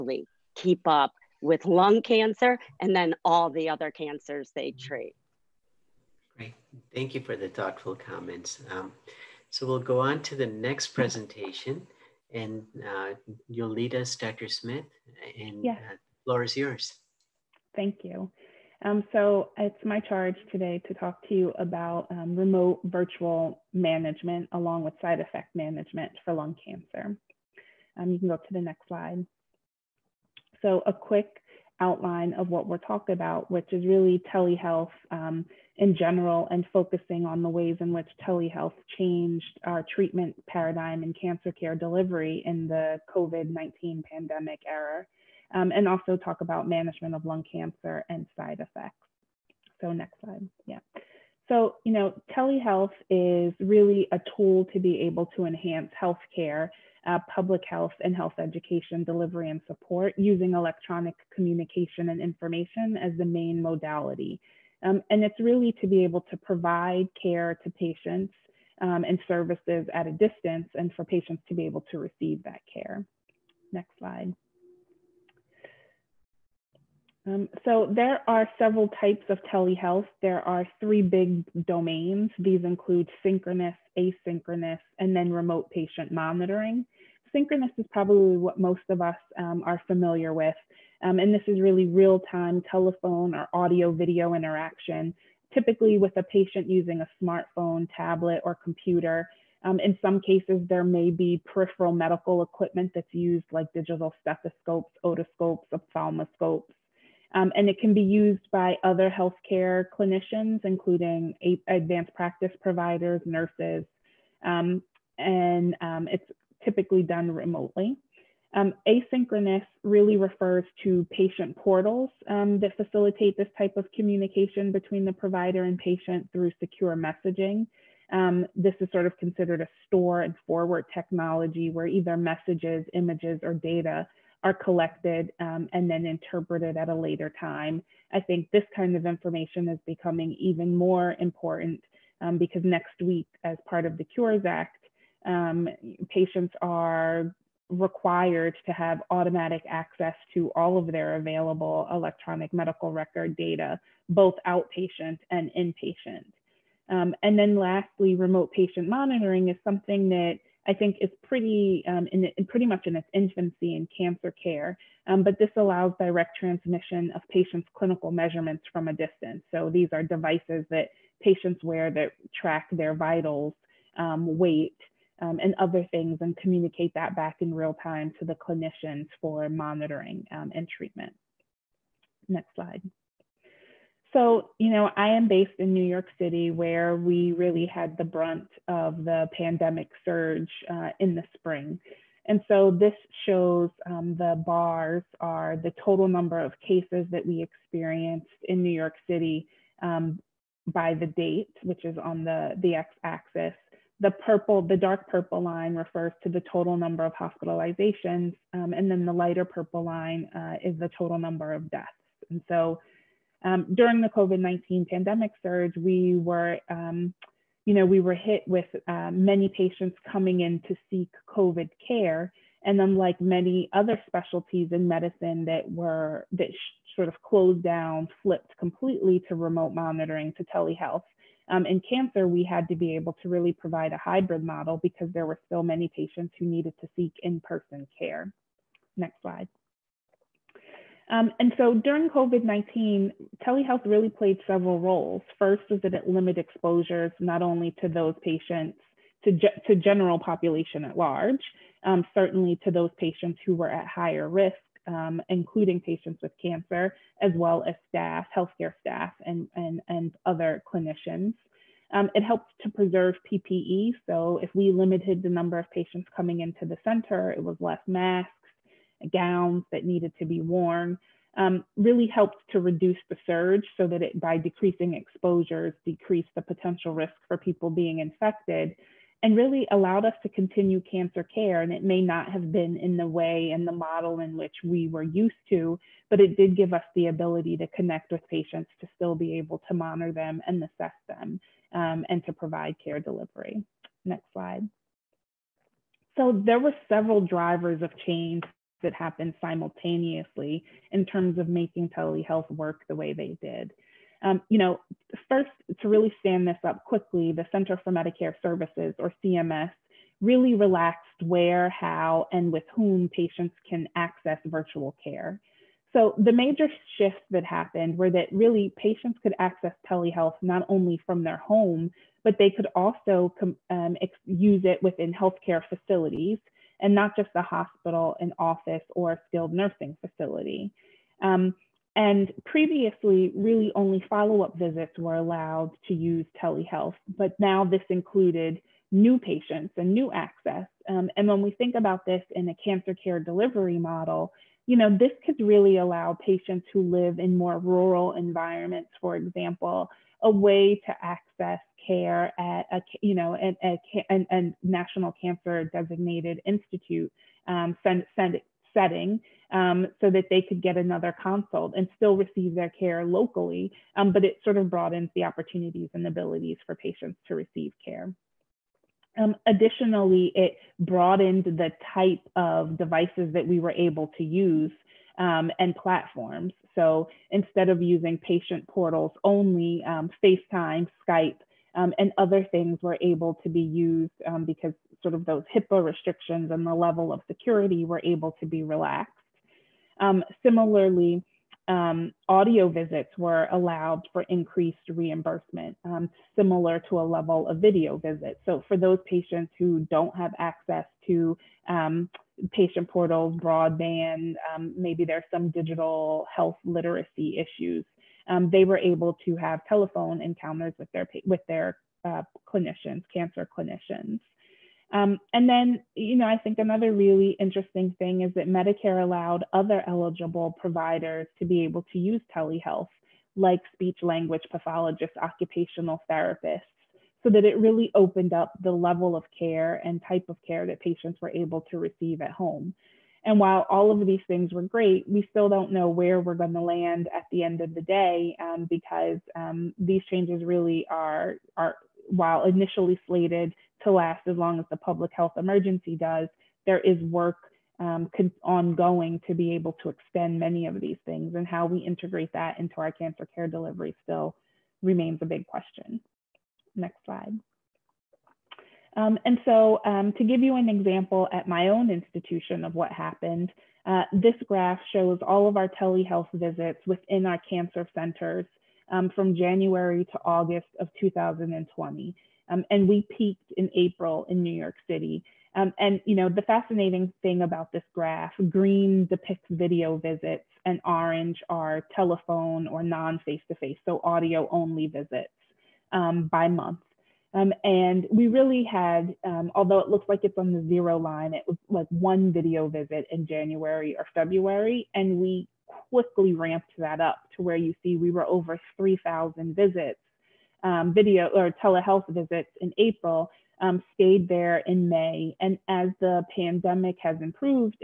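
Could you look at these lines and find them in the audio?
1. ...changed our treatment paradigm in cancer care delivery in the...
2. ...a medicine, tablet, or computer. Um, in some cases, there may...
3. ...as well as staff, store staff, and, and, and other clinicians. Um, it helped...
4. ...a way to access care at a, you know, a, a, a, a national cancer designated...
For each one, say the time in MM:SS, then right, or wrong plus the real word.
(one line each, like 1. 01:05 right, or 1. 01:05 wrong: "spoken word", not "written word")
1. 00:38 right
2. 01:37 wrong: "smartphone", not "medicine"
3. 04:17 wrong: "healthcare", not "store"
4. 05:50 right.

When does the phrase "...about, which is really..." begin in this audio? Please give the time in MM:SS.
00:33.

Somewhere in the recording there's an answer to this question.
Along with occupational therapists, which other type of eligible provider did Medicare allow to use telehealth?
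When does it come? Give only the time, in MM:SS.
07:03.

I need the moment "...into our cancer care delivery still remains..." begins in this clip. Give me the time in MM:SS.
07:32.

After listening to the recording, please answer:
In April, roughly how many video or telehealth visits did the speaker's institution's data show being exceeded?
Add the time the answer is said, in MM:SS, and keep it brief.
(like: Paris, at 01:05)
3,000, at 08:18.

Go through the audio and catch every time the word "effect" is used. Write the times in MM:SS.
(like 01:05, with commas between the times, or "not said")
00:25, 00:48.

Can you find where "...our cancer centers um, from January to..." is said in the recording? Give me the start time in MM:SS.
07:47.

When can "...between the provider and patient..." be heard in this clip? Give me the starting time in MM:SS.
02:04.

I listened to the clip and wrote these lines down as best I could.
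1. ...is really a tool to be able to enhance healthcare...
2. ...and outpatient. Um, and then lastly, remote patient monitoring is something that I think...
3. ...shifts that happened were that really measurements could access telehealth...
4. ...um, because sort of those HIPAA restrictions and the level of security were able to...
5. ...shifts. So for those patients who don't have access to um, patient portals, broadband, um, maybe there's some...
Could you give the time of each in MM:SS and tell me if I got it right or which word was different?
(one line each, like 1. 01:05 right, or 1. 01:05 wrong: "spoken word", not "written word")
1. 00:53 right
2. 02:35 wrong: "inpatient", not "outpatient"
3. 05:16 wrong: "patients", not "measurements"
4. 06:24 right
5. 06:37 wrong: "visits", not "shifts".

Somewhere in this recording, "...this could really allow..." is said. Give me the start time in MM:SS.
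05:44.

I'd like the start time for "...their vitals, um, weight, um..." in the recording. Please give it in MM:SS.
02:52.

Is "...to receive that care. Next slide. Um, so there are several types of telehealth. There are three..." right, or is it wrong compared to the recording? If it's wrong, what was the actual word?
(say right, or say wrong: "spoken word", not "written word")
right.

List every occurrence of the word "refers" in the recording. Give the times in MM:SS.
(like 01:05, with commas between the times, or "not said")
02:00, 03:25.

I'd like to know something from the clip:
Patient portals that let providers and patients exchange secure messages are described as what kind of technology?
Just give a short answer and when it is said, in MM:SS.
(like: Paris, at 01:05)
store and forward, at 02:09.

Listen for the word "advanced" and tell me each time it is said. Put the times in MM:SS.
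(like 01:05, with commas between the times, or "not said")
01:51.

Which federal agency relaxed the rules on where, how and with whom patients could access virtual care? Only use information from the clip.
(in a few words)
Center for Medicare Services.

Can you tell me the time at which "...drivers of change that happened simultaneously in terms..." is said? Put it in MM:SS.
04:57.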